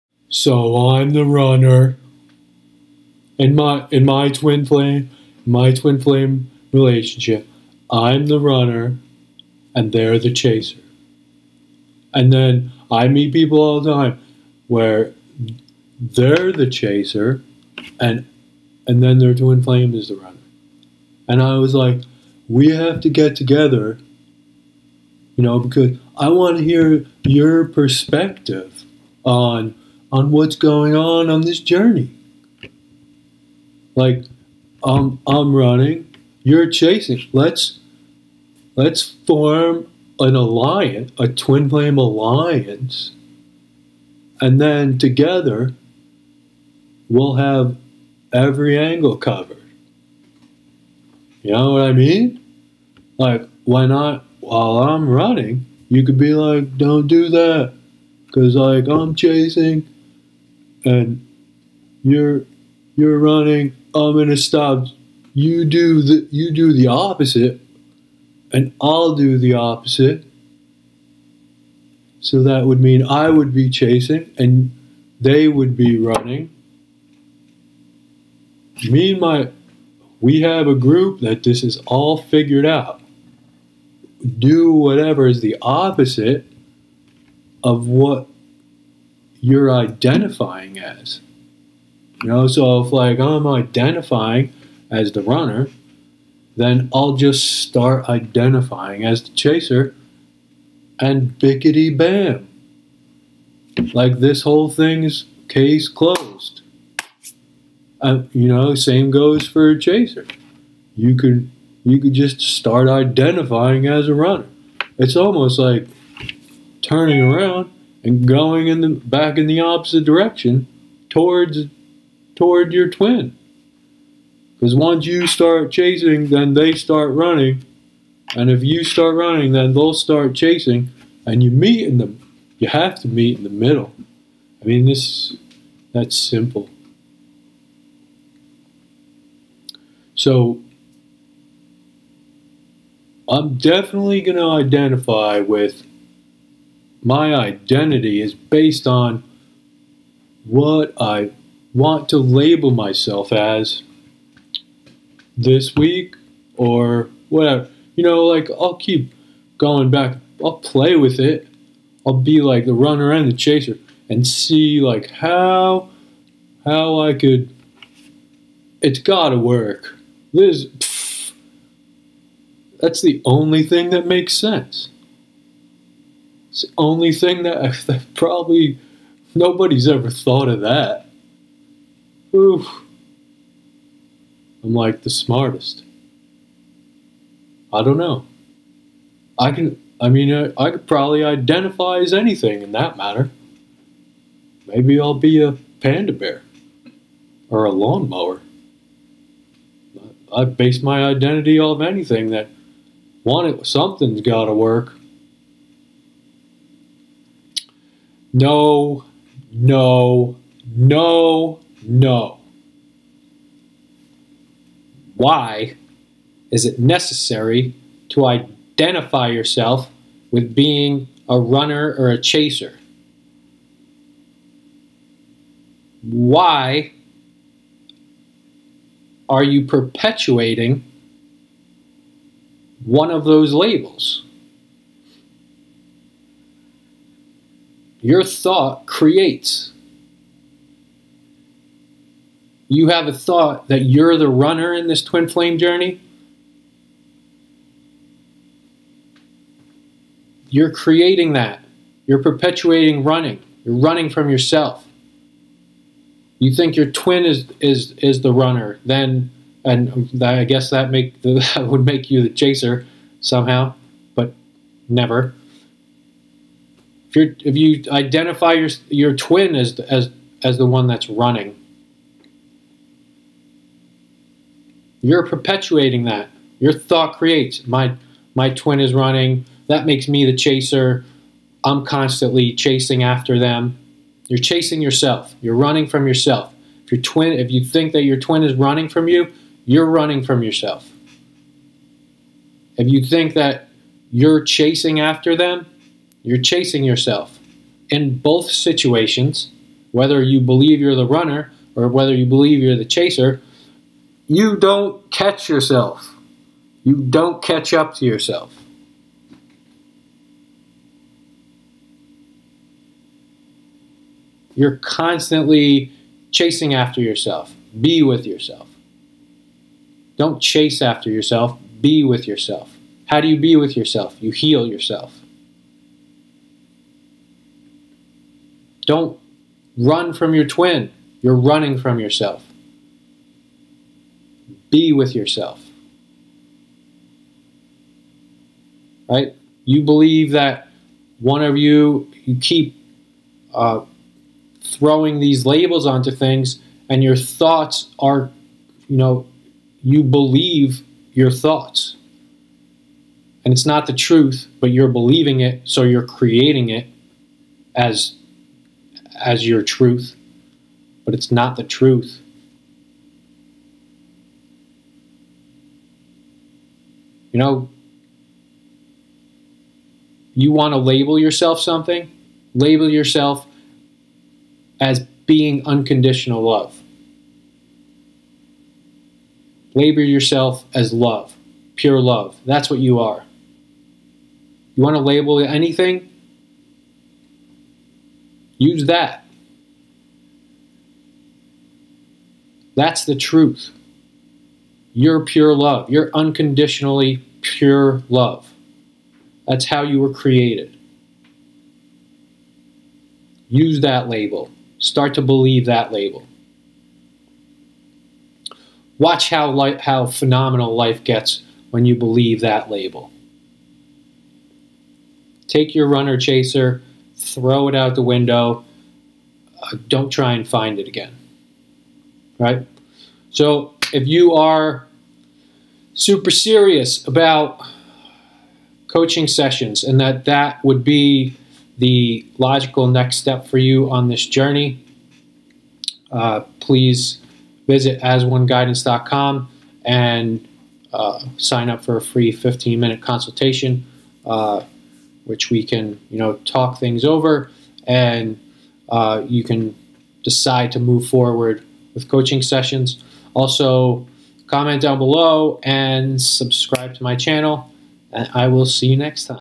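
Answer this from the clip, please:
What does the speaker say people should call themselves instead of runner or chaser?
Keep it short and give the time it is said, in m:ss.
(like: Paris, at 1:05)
Unconditional love, at 6:15.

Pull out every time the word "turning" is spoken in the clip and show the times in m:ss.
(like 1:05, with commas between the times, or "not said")
1:56.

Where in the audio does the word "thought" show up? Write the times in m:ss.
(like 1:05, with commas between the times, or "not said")
3:00, 3:58, 4:03, 4:36, 5:47, 5:51.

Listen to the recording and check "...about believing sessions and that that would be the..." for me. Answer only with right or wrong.
wrong.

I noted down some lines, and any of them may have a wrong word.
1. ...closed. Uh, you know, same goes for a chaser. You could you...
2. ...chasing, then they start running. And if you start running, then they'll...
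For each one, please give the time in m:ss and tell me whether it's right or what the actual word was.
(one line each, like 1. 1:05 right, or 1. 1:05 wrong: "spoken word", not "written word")
1. 1:45 right
2. 2:05 right.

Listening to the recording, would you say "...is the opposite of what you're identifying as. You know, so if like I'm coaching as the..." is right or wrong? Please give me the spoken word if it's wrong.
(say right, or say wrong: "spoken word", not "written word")
wrong: "identifying", not "coaching".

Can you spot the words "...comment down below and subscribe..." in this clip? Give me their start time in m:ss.
7:34.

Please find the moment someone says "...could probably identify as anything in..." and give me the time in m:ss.
3:10.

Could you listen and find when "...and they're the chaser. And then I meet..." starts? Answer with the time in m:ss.
0:09.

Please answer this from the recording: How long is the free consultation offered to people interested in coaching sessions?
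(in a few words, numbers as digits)
15 minutes.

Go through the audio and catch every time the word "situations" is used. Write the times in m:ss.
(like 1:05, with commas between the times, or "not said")
4:58.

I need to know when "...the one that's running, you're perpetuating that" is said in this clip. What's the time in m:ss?
4:30.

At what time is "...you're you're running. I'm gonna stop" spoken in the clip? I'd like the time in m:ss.
1:02.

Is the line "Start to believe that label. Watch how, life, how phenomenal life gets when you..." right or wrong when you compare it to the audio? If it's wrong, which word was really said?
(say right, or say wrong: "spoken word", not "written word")
right.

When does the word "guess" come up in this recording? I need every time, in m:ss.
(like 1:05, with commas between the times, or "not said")
4:20.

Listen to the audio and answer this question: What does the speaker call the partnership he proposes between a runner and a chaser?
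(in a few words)
Twin flame alliance.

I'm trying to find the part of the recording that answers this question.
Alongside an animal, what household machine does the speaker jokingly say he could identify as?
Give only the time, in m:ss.
3:17.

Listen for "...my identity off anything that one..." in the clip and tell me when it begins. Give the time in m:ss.
3:20.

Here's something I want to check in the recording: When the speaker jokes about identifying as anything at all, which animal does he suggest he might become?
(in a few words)
Panda bear.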